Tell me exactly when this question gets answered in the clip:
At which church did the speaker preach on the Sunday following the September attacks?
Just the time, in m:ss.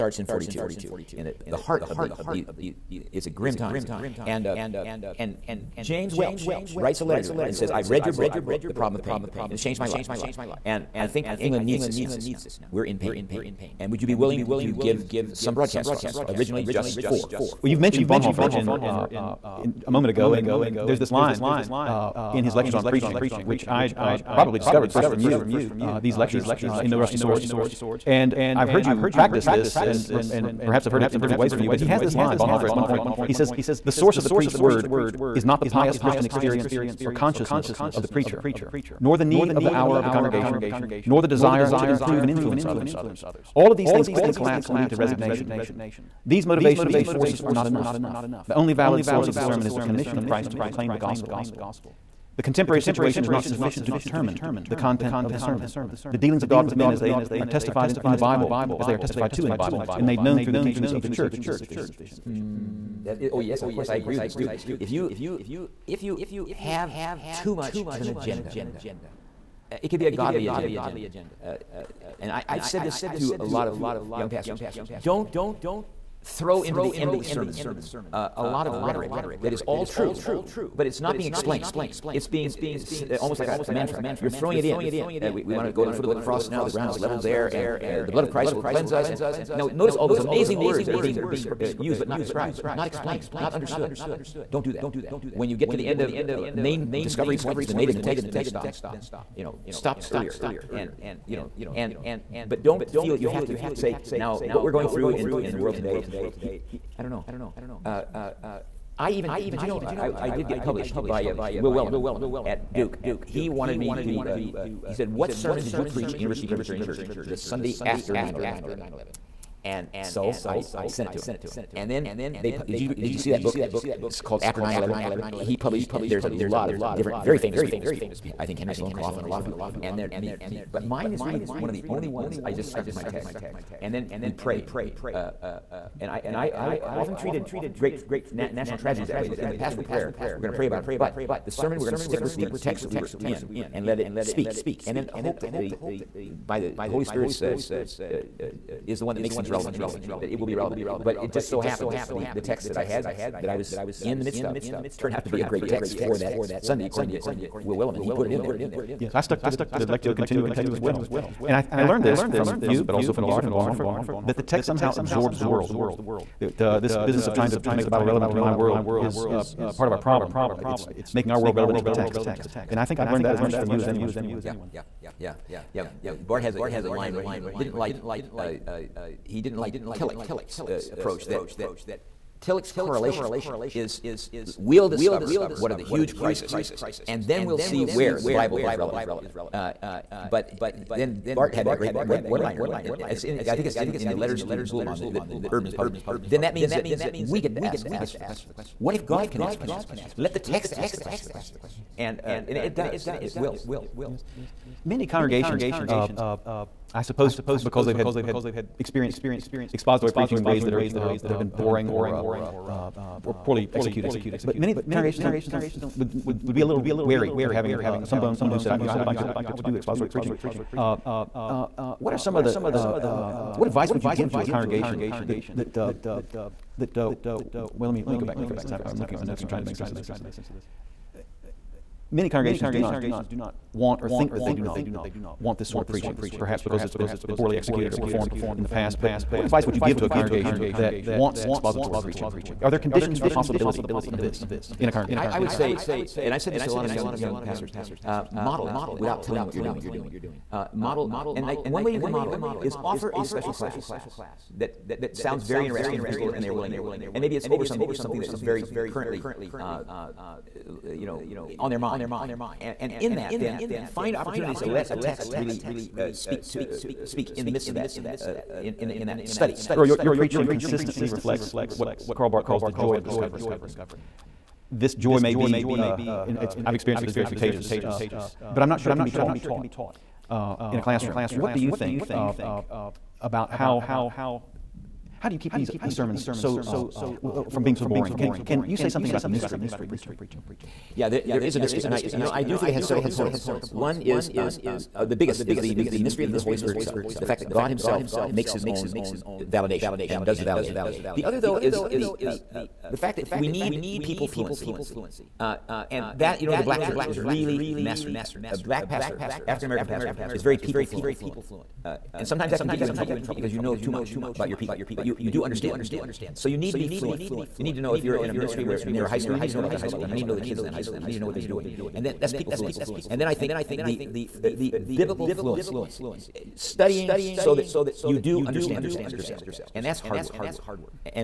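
1:56.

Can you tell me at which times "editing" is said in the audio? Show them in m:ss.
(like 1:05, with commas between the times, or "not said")
not said.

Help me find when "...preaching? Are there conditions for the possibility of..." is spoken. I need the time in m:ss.
4:01.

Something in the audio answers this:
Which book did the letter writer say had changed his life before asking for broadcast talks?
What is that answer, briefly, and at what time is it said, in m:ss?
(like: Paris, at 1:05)
The Problem of Pain, at 0:08.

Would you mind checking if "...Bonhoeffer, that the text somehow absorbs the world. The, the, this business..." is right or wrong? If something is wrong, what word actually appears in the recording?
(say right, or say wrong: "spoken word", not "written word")
right.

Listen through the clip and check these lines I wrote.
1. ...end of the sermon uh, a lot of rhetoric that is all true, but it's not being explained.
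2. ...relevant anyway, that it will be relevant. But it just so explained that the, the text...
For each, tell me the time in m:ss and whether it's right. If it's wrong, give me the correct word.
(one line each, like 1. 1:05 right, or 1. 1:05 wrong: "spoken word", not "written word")
1. 1:16 right
2. 2:29 wrong: "happened", not "explained".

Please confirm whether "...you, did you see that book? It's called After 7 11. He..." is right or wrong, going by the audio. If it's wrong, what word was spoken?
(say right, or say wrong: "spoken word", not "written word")
wrong: "9", not "7".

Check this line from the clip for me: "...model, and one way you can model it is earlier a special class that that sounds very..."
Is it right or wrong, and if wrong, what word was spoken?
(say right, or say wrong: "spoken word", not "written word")
wrong: "offer", not "earlier".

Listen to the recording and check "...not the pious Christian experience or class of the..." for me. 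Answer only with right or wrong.
wrong.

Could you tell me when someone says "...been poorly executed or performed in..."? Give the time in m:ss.
3:56.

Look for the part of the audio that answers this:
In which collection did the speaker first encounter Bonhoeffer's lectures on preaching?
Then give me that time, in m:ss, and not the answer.
0:26.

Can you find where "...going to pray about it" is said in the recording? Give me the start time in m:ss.
2:20.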